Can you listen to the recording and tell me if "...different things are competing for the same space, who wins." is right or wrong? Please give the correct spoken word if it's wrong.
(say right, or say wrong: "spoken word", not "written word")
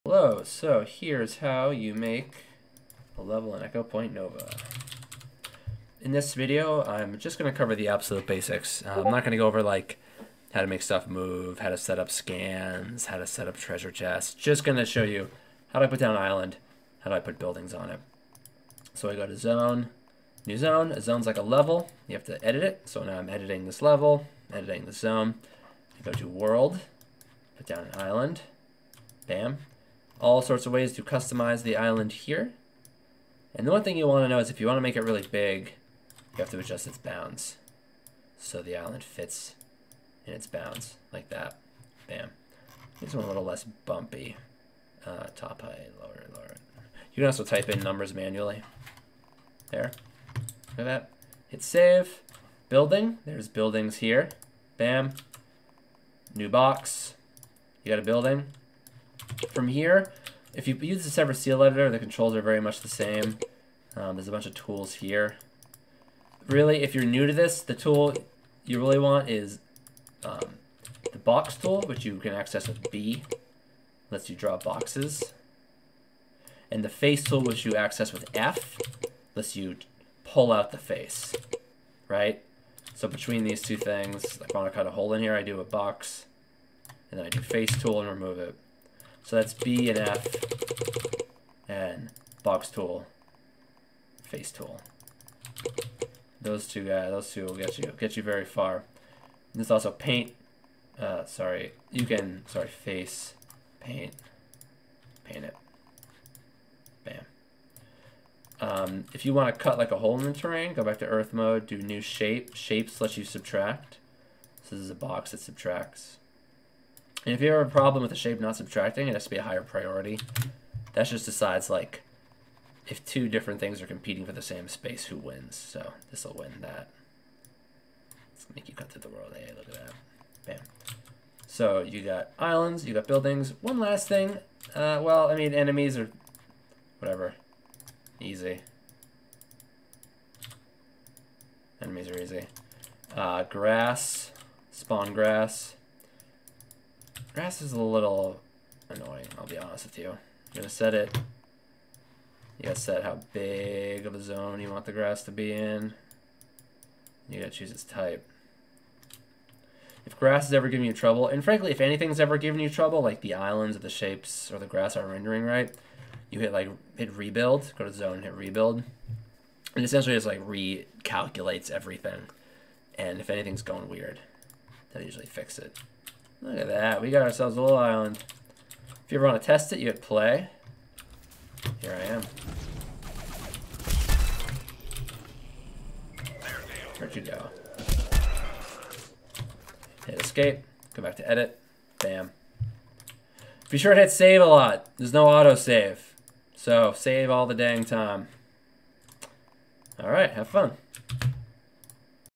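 right.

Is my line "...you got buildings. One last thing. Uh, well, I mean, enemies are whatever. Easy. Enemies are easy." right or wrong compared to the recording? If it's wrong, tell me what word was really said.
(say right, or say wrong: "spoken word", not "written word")
right.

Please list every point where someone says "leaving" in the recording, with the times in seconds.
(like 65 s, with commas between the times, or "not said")
not said.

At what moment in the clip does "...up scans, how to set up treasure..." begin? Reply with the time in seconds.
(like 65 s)
11 s.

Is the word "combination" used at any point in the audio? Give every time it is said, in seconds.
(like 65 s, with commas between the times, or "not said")
not said.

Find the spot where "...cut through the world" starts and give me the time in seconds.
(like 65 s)
128 s.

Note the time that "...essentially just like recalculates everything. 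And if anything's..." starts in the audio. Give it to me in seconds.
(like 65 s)
169 s.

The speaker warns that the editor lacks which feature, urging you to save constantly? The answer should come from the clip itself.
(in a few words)
Autosave.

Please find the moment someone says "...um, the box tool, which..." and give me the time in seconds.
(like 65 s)
70 s.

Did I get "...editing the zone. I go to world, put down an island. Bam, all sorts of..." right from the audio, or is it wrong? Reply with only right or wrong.
right.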